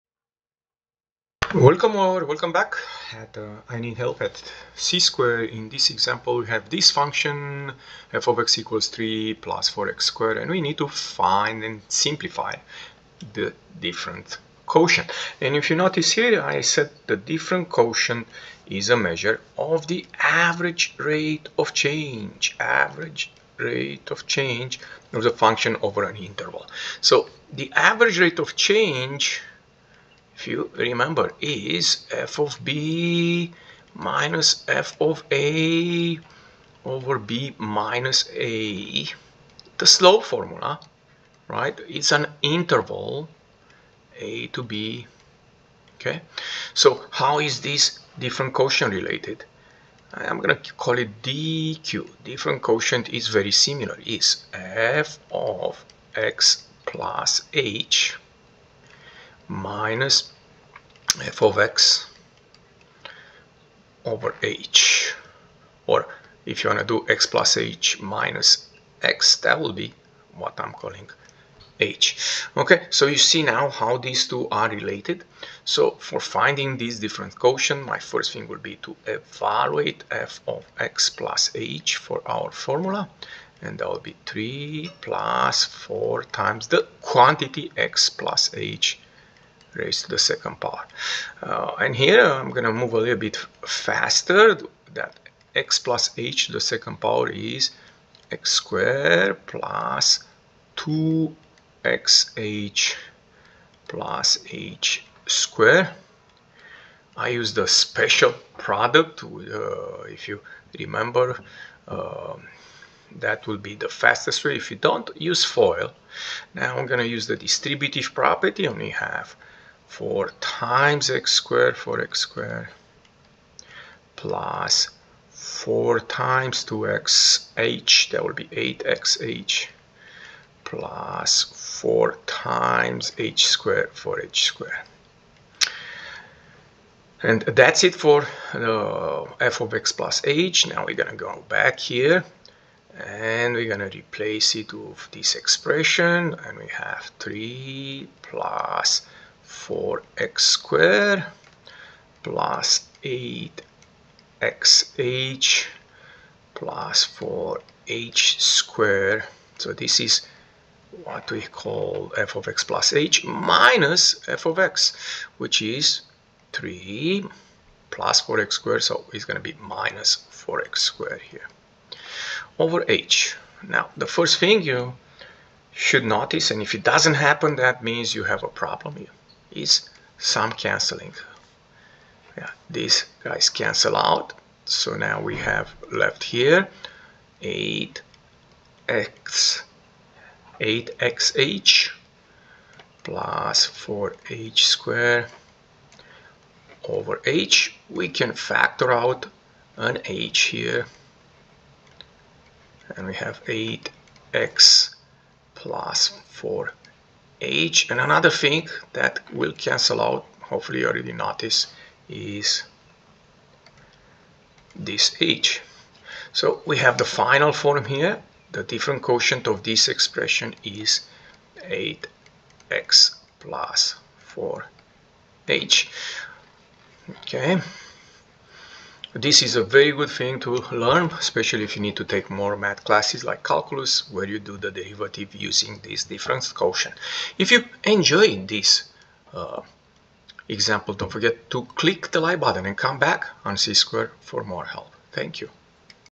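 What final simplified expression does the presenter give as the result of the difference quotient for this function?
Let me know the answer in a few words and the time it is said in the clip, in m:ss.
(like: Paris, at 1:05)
8x + 4h, at 3:41.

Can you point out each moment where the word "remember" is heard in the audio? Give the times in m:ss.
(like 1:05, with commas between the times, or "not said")
0:30, 1:50.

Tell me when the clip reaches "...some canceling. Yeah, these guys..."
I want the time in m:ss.
3:00.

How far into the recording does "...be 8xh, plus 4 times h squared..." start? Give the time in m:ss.
2:08.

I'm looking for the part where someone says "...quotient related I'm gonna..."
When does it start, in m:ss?
0:48.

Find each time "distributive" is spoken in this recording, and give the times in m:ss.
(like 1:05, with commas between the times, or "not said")
1:57.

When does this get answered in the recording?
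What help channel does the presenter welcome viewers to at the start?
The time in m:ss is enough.
0:04.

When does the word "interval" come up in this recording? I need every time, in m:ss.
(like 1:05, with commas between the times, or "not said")
0:26, 0:42.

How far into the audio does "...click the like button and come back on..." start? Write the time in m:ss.
4:01.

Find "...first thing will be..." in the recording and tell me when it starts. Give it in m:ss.
1:17.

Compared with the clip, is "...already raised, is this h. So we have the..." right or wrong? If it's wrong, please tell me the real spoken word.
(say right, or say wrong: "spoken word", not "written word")
wrong: "noticed", not "raised".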